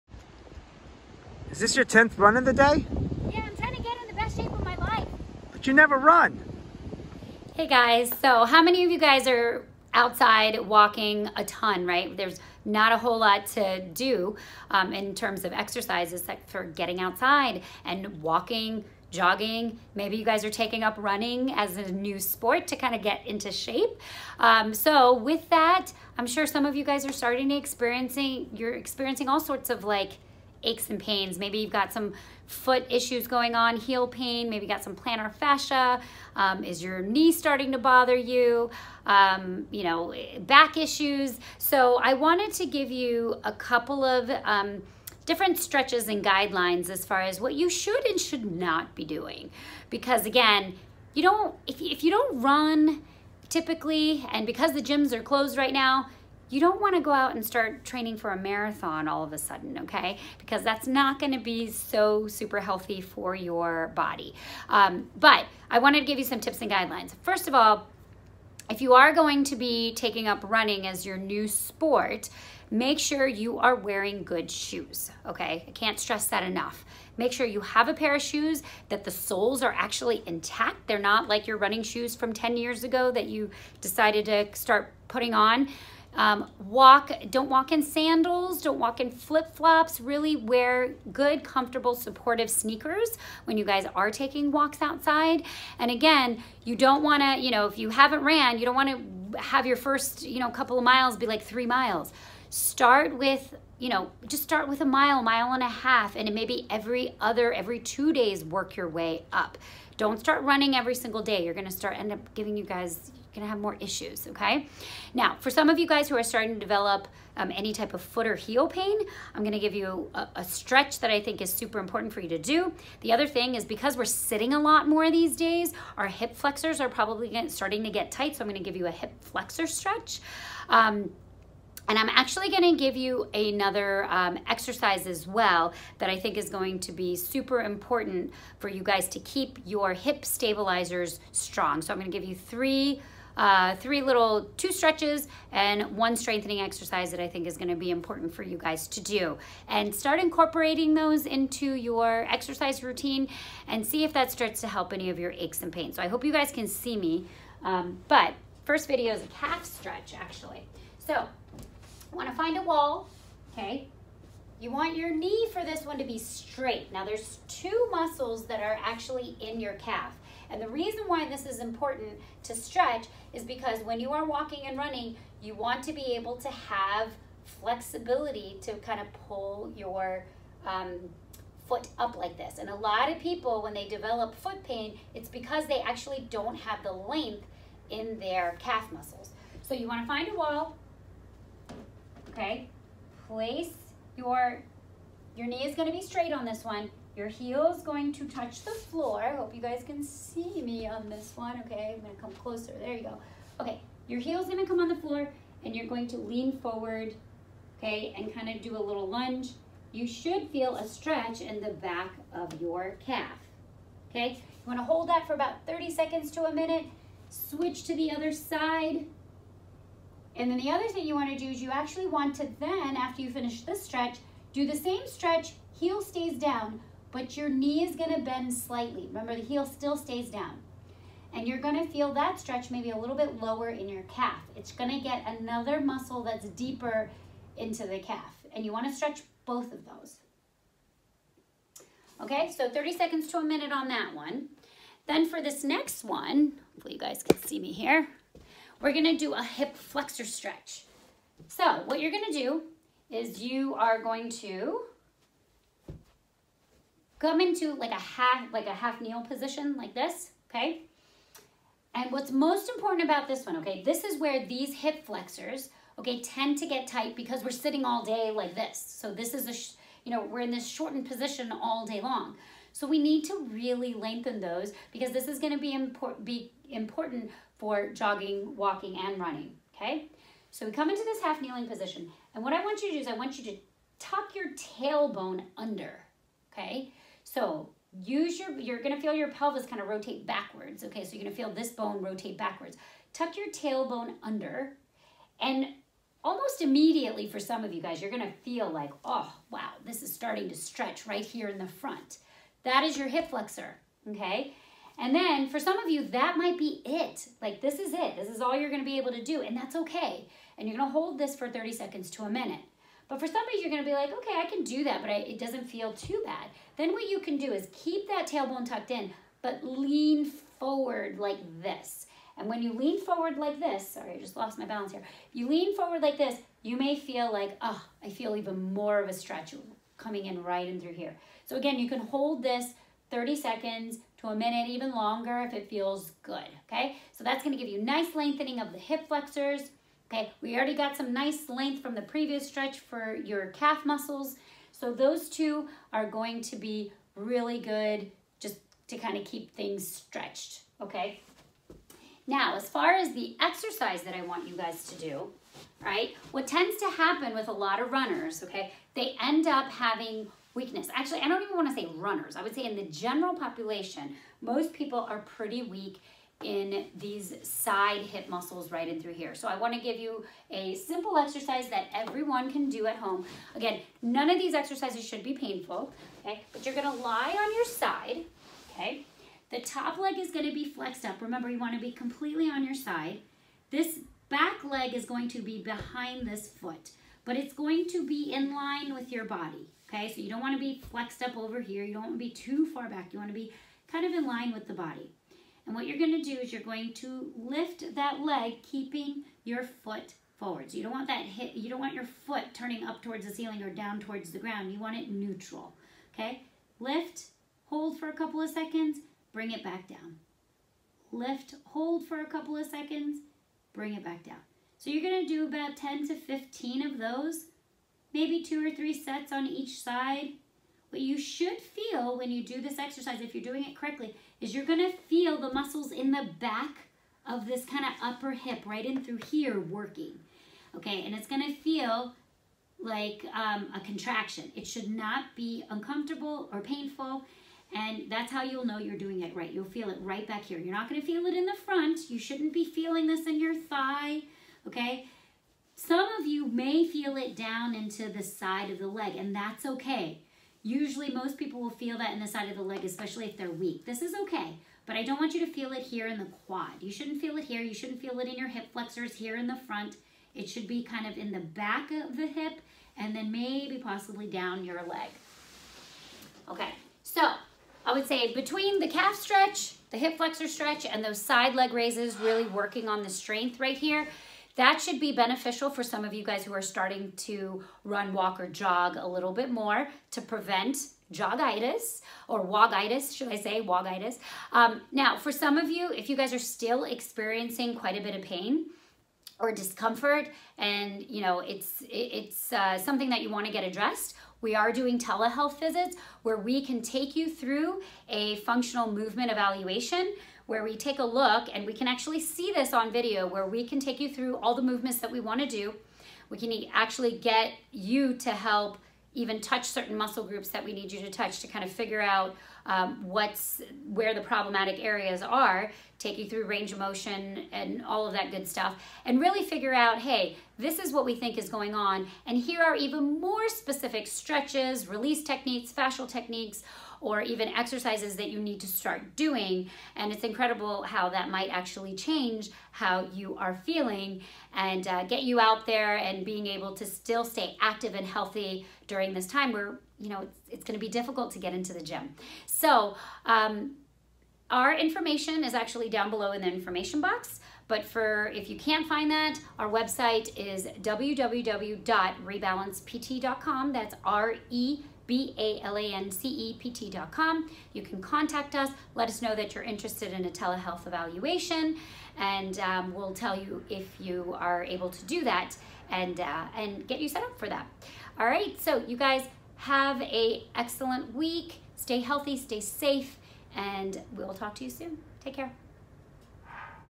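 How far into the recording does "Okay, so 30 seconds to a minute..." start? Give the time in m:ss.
4:02.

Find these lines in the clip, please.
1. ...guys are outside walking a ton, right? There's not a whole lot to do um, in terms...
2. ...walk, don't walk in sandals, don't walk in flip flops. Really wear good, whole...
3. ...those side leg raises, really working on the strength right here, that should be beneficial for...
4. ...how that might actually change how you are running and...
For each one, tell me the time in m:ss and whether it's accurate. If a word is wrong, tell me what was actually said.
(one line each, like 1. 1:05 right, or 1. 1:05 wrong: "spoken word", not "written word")
1. 0:08 right
2. 1:26 wrong: "comfortable", not "whole"
3. 7:51 right
4. 8:50 wrong: "feeling", not "running".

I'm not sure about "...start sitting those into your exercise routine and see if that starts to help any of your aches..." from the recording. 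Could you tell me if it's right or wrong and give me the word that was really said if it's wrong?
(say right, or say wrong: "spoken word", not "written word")
wrong: "incorporating", not "sitting".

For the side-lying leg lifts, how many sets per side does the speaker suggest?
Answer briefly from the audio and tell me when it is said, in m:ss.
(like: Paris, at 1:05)
2 or 3, at 6:58.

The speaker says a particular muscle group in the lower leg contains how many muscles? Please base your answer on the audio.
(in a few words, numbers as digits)
2.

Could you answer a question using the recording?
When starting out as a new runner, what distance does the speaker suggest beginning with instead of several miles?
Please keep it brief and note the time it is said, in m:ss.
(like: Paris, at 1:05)
a mile, mile and a half, at 1:44.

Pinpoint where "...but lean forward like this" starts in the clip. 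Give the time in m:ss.
5:19.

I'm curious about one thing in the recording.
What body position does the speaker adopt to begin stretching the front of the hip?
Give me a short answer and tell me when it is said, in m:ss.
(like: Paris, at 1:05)
half kneel, at 4:18.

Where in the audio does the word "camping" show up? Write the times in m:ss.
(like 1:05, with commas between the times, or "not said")
not said.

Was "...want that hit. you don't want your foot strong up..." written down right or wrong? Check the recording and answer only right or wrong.
wrong.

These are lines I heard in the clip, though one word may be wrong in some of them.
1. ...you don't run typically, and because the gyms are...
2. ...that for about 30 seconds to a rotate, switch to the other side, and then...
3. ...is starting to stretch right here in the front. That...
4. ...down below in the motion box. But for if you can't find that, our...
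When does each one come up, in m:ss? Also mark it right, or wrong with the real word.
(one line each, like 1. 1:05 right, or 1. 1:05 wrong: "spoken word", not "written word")
1. 0:52 right
2. 3:35 wrong: "minute", not "rotate"
3. 5:00 right
4. 9:05 wrong: "information", not "motion".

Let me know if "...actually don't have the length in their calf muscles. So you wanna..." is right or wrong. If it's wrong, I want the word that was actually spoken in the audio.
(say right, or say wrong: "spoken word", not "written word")
right.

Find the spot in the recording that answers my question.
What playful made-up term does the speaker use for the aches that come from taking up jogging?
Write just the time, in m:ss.
8:01.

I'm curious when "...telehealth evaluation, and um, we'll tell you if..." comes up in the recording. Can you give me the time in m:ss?
9:20.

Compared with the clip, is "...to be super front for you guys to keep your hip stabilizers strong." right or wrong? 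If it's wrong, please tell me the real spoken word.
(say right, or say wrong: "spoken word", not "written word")
wrong: "important", not "front".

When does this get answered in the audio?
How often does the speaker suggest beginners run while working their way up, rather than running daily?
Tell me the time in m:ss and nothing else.
1:47.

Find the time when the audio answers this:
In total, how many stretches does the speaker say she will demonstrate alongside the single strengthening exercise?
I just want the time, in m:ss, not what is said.
2:24.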